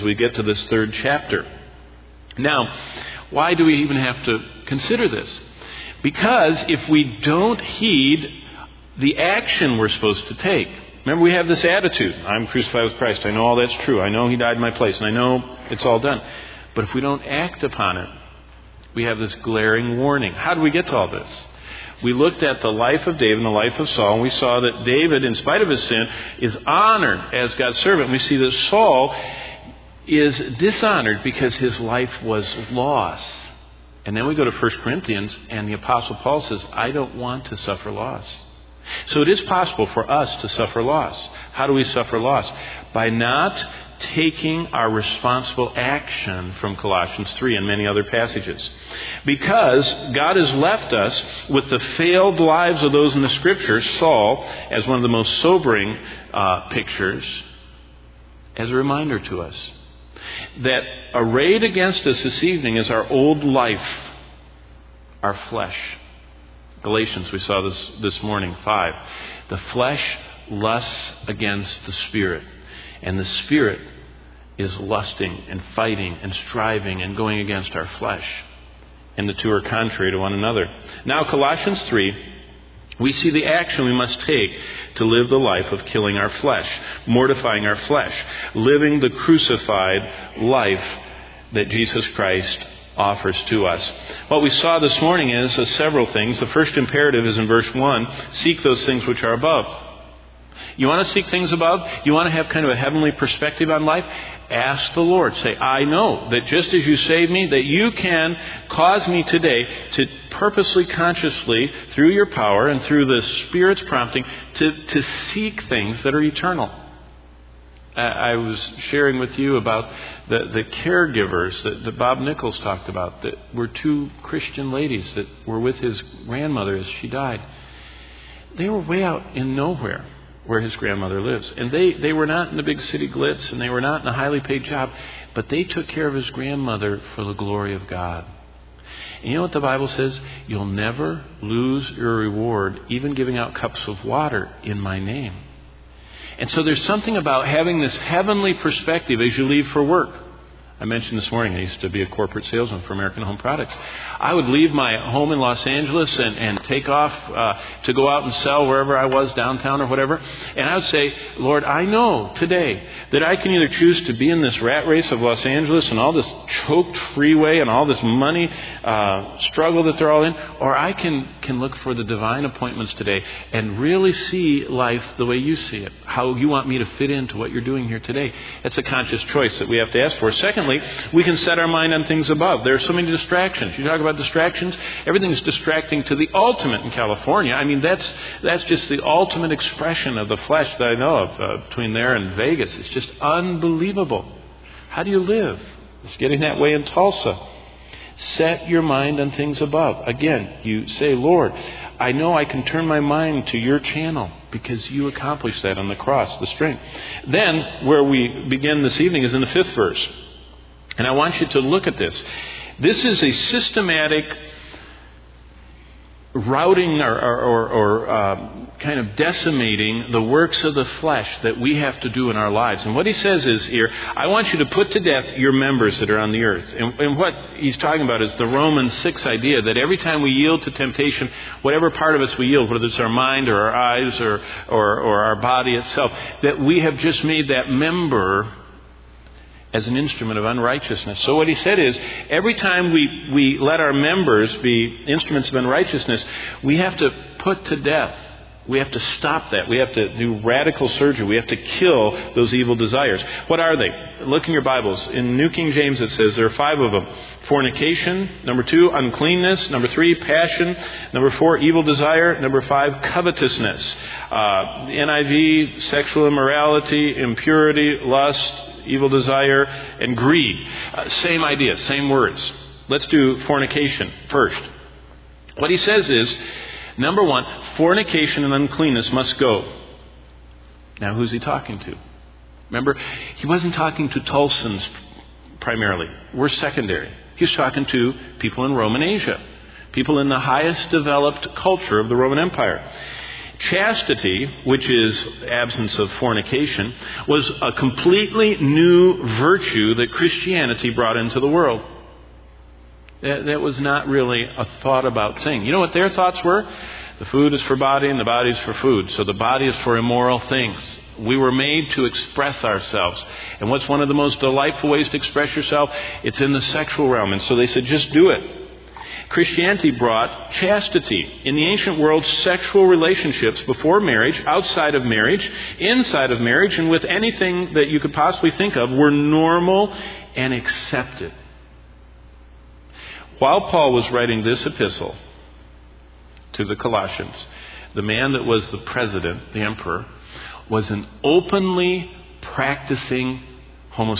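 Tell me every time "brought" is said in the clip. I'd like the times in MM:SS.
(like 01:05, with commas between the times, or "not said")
05:00, 05:19.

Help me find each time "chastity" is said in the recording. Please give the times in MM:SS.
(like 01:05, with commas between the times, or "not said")
04:53, 05:20.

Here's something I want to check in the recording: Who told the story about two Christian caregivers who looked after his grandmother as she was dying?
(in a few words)
Bob Nichols.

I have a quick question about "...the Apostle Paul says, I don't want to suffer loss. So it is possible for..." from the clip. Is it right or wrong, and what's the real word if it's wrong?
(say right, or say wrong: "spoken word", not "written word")
right.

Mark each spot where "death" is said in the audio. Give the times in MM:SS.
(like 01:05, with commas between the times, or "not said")
03:44, 04:07.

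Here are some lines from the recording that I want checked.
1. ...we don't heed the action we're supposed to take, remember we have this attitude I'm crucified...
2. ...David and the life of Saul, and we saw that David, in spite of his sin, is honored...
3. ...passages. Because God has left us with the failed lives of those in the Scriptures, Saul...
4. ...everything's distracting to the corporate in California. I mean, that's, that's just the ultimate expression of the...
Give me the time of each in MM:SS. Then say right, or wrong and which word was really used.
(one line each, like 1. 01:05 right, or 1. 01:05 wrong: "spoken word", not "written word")
1. 00:06 right
2. 00:23 right
3. 00:48 right
4. 03:05 wrong: "ultimate", not "corporate".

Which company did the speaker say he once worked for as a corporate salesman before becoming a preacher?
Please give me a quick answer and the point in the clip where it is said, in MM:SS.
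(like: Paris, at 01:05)
American Home Products, at 02:32.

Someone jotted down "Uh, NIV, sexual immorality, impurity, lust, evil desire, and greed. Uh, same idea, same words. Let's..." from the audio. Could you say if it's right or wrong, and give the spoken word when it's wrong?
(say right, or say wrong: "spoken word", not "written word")
right.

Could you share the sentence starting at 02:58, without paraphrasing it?
That's a conscious choice that we have to ask for.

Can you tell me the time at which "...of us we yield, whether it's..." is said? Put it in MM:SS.
03:52.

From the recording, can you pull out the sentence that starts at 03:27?
Then, where we begin this evening is in the fifth verse.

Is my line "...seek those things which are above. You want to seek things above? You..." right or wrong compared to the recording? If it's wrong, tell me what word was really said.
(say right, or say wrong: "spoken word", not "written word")
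right.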